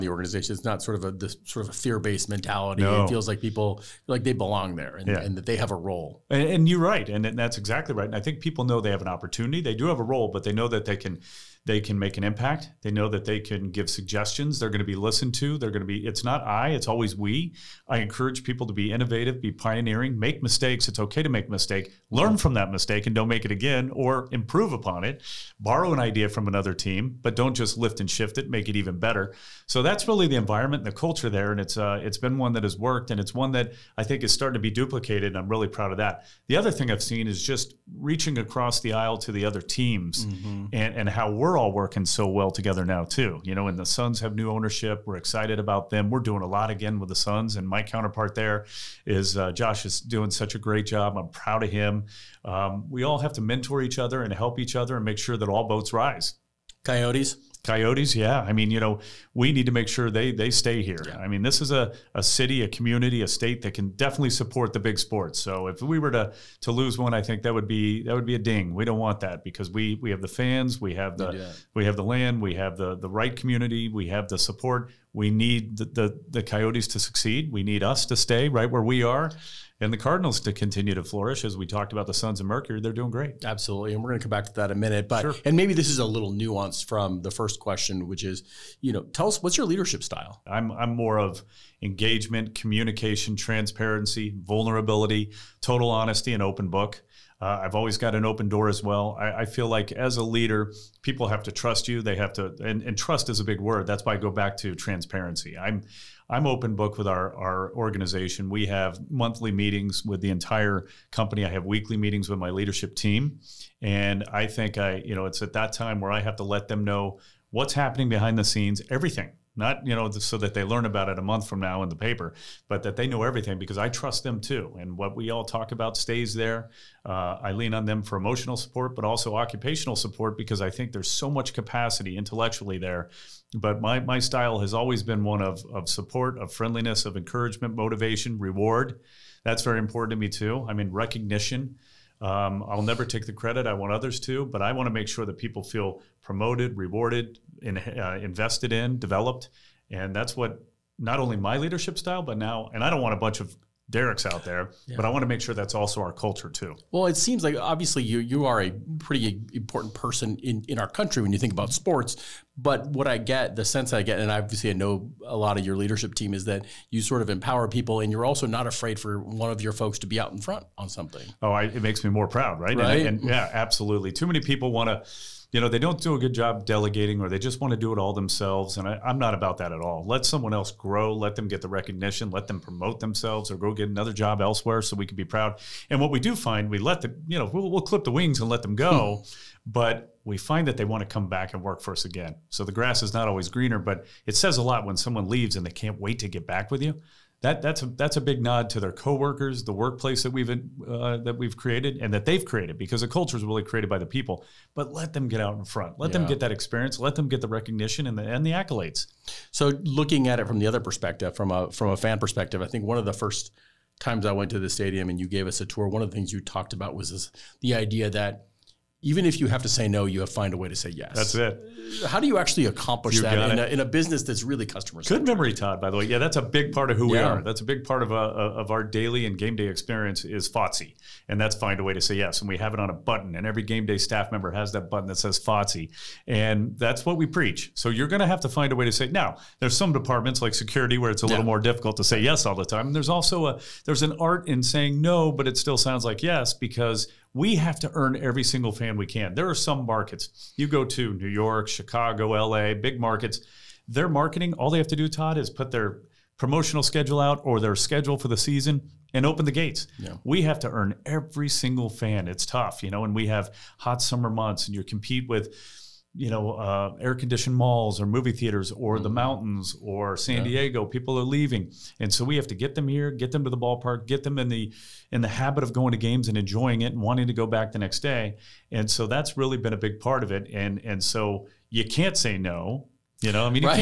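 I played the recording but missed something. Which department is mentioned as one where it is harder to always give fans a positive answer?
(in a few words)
Security.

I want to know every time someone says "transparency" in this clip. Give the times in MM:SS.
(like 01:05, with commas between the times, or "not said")
01:33, 01:44.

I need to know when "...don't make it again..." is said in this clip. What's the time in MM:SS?
00:23.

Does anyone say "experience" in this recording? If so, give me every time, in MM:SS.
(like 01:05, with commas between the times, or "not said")
03:26, 03:49.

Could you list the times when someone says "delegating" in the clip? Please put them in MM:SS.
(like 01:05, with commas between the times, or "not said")
02:56.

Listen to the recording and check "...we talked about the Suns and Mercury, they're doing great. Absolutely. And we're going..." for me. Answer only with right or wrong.
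right.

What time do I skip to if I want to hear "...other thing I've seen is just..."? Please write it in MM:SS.
00:36.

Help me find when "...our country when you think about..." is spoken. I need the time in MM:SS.
02:40.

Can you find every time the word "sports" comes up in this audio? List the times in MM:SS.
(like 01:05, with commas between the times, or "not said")
01:04, 02:41.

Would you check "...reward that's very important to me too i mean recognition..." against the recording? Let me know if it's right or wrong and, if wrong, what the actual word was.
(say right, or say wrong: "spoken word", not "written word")
right.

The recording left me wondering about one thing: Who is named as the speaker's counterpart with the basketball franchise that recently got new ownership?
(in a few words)
Josh.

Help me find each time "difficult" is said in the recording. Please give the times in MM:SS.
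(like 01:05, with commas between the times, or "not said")
04:01.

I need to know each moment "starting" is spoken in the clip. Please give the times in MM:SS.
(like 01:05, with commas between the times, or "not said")
00:34.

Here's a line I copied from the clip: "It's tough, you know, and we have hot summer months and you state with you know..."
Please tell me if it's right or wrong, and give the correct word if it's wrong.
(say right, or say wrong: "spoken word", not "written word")
wrong: "compete", not "state".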